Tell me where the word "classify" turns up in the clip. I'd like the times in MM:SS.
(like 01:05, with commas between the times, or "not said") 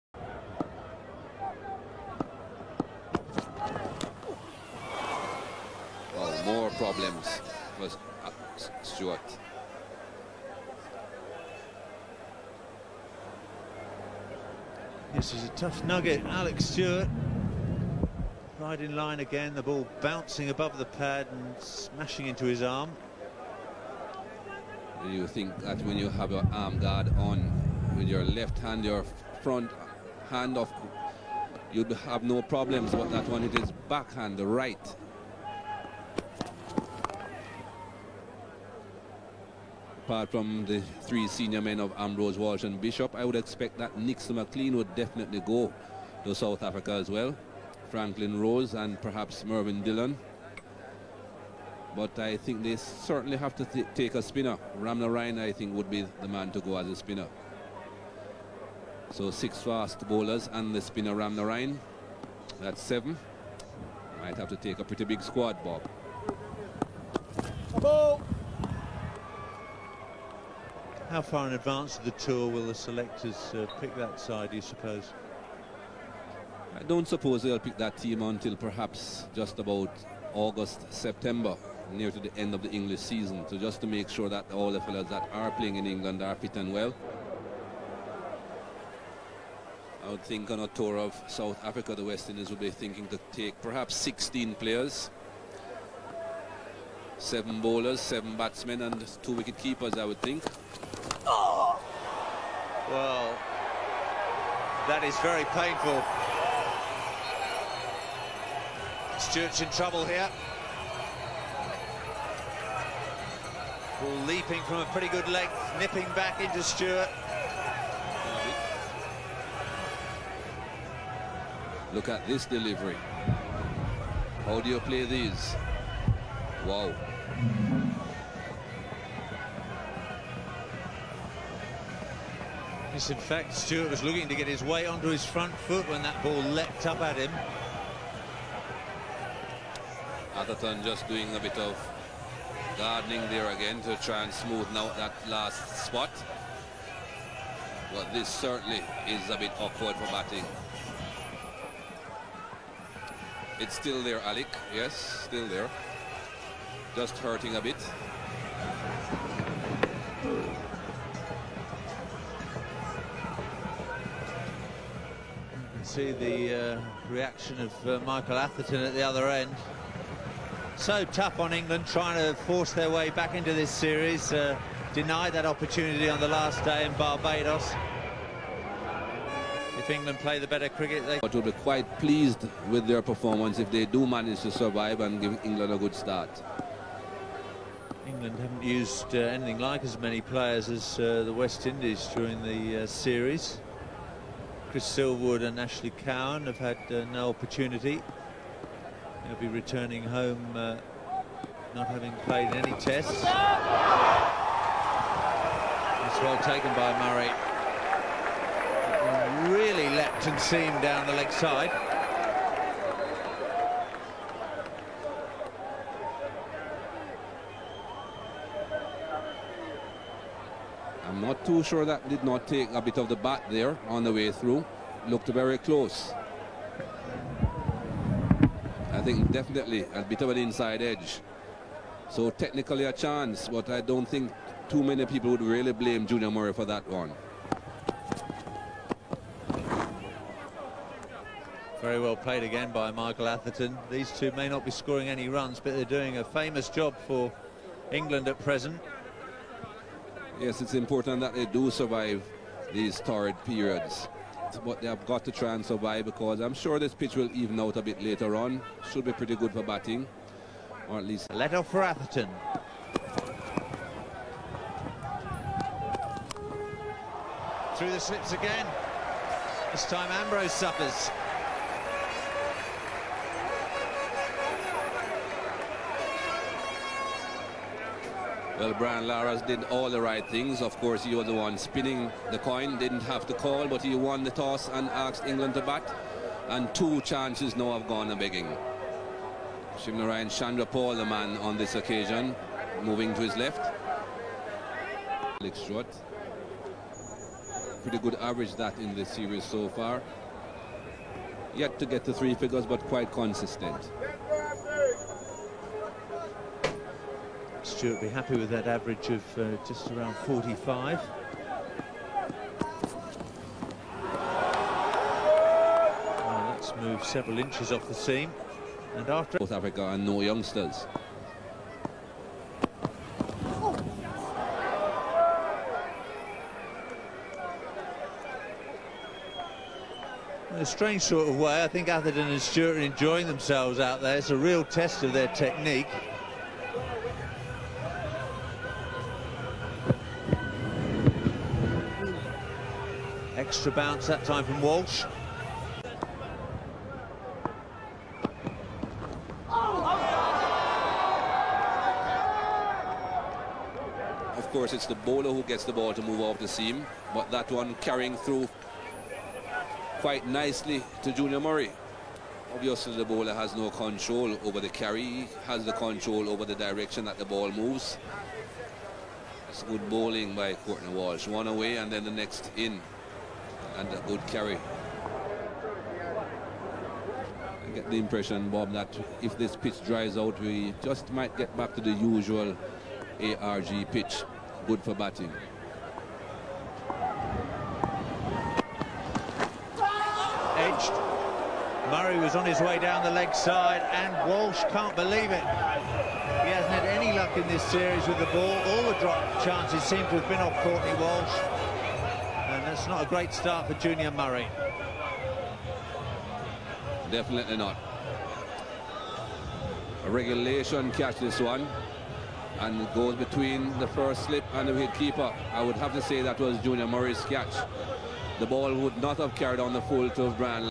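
not said.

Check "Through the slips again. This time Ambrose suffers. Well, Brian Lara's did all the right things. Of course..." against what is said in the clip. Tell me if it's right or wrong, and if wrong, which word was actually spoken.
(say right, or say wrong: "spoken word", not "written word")
right.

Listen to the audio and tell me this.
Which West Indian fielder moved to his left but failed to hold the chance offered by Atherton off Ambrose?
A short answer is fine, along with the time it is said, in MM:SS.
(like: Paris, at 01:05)
Shivnarine Chanderpaul, at 04:49.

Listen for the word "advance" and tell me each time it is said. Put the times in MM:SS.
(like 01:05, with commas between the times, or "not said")
01:11.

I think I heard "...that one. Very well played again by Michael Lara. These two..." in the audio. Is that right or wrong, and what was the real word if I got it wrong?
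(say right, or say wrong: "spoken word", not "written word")
wrong: "Atherton", not "Lara".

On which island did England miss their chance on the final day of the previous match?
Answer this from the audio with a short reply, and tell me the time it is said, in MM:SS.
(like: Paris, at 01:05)
Barbados, at 02:56.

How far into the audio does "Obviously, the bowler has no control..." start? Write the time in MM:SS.
06:02.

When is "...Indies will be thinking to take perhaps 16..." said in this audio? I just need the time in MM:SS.
01:32.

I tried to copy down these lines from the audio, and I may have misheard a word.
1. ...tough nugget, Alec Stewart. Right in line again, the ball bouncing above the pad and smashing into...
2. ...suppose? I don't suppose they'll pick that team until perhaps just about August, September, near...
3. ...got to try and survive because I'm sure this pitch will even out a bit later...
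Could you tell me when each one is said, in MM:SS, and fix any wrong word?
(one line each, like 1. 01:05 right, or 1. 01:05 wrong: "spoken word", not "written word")
1. 00:15 right
2. 01:14 right
3. 04:15 right.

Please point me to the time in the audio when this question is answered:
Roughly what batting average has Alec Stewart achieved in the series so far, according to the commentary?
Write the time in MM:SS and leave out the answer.
05:09.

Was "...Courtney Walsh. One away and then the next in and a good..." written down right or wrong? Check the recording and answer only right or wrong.
right.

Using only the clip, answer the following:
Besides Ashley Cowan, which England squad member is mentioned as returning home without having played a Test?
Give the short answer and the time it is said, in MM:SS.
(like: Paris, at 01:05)
Chris Silverwood, at 03:14.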